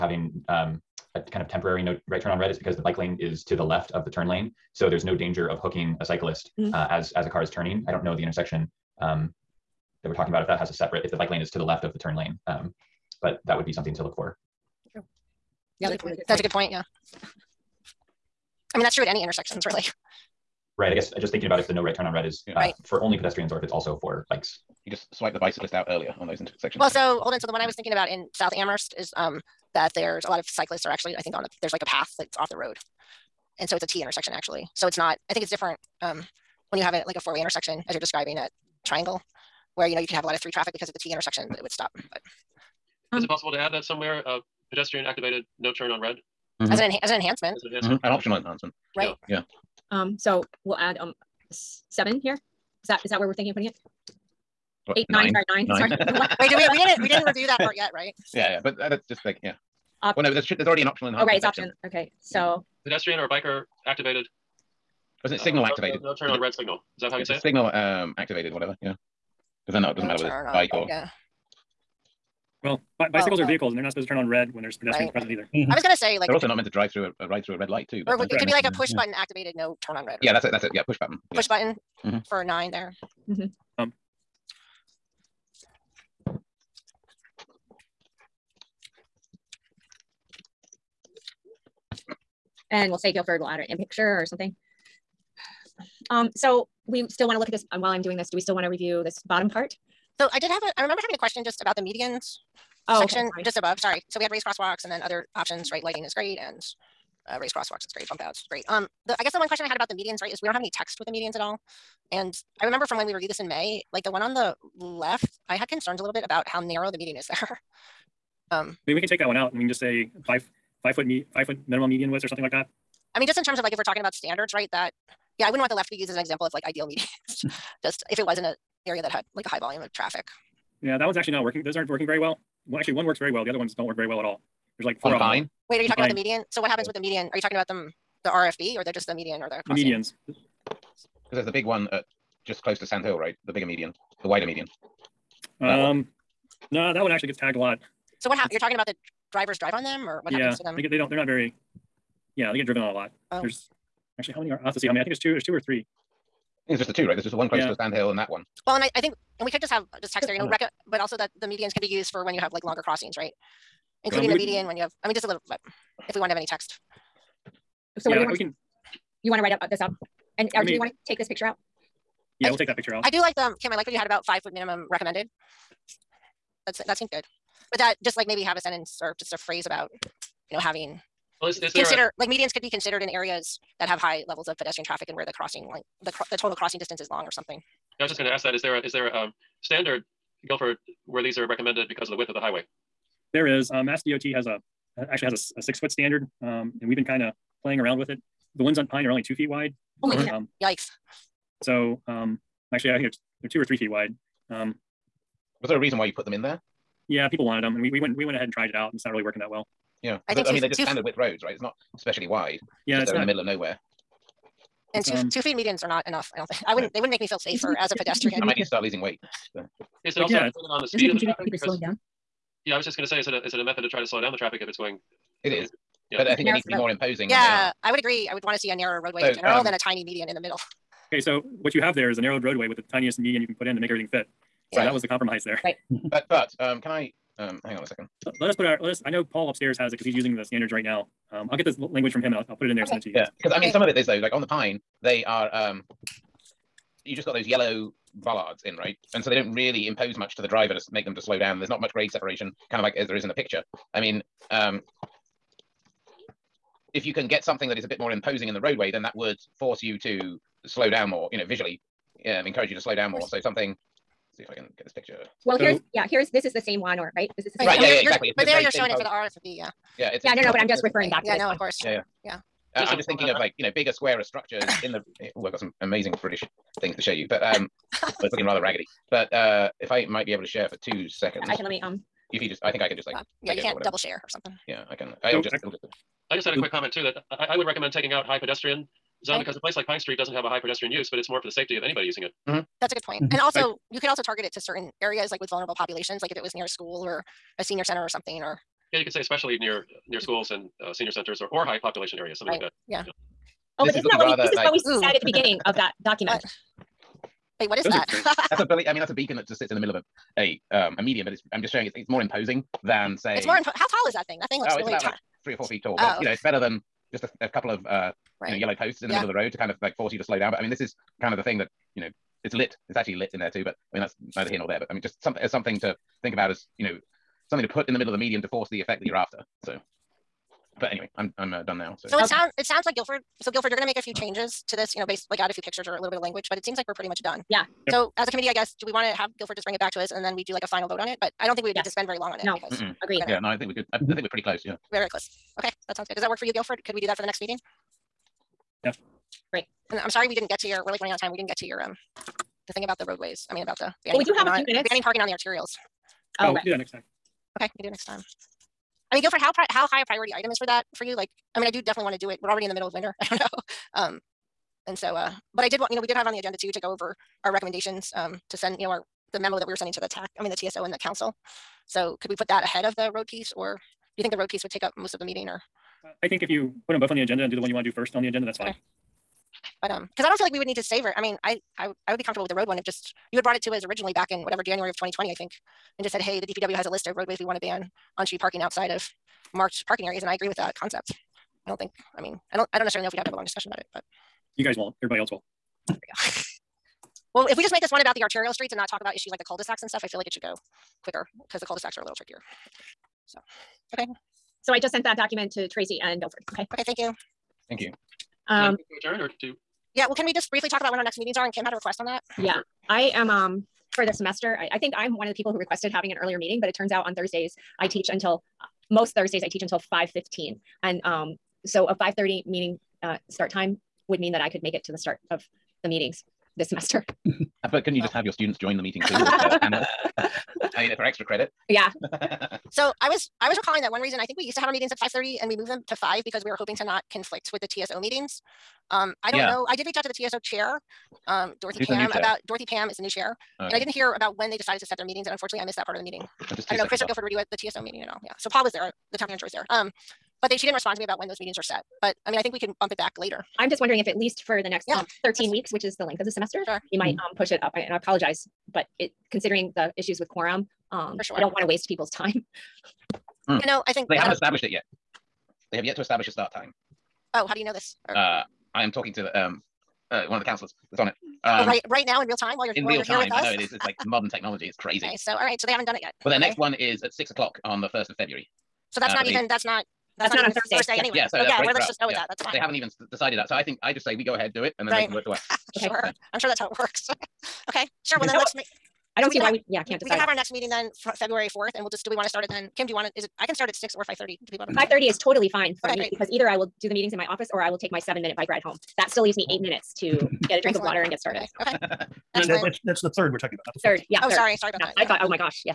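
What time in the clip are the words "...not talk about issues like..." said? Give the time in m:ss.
6:38.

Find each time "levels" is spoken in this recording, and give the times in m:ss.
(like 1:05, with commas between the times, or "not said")
3:04.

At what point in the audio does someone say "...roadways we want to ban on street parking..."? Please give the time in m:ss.
6:27.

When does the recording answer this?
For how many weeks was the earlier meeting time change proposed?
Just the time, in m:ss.
7:35.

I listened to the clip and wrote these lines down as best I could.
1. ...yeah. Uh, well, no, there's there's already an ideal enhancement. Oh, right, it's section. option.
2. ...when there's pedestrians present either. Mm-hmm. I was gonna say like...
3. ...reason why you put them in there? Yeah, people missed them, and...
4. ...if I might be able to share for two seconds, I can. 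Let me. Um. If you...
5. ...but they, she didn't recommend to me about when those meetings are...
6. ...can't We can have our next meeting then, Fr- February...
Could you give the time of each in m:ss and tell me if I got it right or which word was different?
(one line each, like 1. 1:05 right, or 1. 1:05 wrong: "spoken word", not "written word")
1. 0:59 wrong: "optional", not "ideal"
2. 1:14 right
3. 3:25 wrong: "wanted", not "missed"
4. 4:39 right
5. 7:30 wrong: "respond", not "recommend"
6. 8:09 right.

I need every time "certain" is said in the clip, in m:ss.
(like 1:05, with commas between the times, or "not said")
4:54.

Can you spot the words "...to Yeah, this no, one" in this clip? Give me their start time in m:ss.
4:31.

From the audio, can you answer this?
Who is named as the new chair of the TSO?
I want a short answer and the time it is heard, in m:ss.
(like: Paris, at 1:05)
Dorothy Pam, at 7:22.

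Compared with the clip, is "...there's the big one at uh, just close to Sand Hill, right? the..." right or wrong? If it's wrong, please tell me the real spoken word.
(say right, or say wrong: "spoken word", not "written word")
right.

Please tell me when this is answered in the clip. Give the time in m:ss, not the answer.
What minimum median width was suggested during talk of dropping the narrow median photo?
2:01.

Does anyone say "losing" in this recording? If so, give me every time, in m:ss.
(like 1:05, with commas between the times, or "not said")
3:38.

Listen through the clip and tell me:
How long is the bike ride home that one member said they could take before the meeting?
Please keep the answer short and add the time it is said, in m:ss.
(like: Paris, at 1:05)
7 minutes, at 8:17.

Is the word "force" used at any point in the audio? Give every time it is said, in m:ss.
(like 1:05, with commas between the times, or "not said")
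4:19, 5:19, 5:28.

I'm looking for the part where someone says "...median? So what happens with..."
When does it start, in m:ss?
2:16.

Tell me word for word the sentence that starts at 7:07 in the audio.
Uh, but couldn't you just have your students join the meeting too?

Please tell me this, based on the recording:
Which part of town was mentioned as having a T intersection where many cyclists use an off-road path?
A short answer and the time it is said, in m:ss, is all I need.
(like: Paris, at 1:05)
South Amherst, at 0:28.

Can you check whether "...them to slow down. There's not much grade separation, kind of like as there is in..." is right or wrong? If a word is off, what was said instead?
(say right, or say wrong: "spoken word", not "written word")
right.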